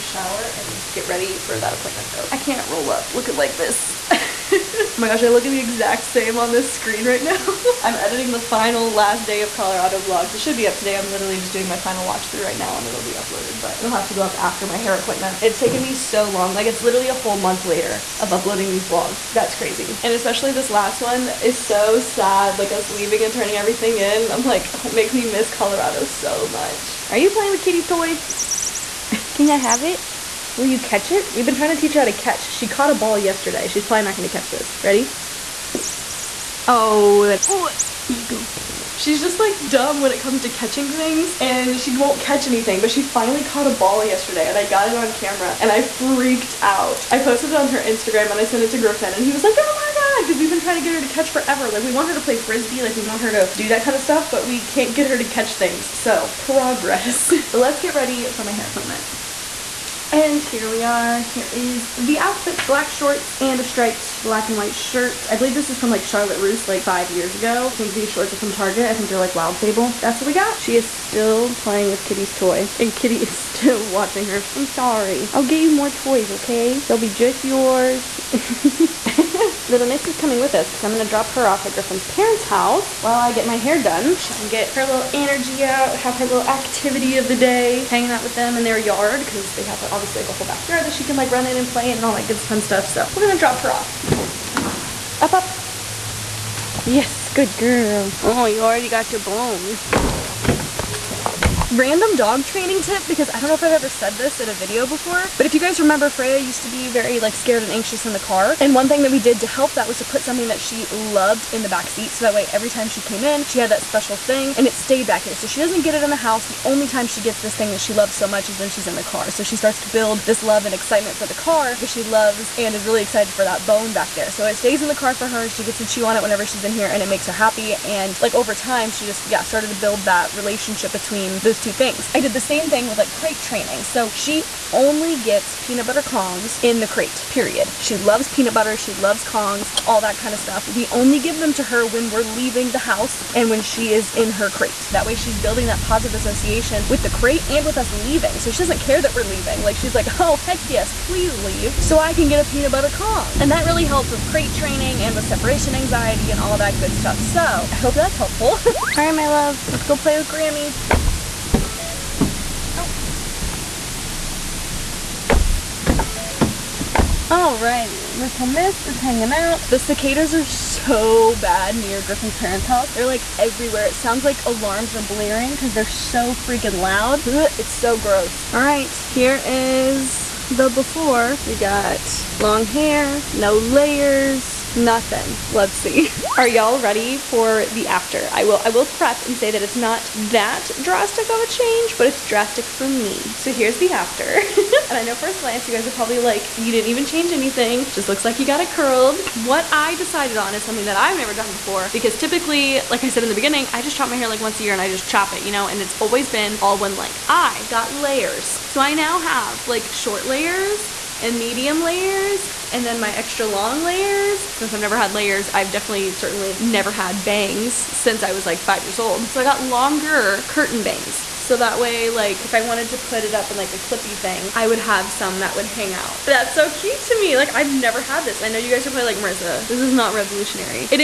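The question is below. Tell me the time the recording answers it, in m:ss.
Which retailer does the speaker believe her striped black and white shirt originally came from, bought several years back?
1:06.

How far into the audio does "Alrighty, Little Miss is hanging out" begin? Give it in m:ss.
2:47.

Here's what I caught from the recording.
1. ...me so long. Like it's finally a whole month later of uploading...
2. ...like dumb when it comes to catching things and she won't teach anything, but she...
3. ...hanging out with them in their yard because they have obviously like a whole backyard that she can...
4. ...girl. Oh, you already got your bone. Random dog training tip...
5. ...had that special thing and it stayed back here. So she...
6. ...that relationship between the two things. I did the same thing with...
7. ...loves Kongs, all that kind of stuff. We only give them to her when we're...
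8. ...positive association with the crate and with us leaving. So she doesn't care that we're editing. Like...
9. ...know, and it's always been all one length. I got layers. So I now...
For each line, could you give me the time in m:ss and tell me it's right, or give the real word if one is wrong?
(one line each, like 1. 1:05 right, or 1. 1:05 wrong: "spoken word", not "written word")
1. 0:15 wrong: "literally", not "finally"
2. 0:39 wrong: "catch", not "teach"
3. 1:27 right
4. 1:37 right
5. 1:53 right
6. 2:10 right
7. 2:18 right
8. 2:25 wrong: "leaving", not "editing"
9. 3:25 right.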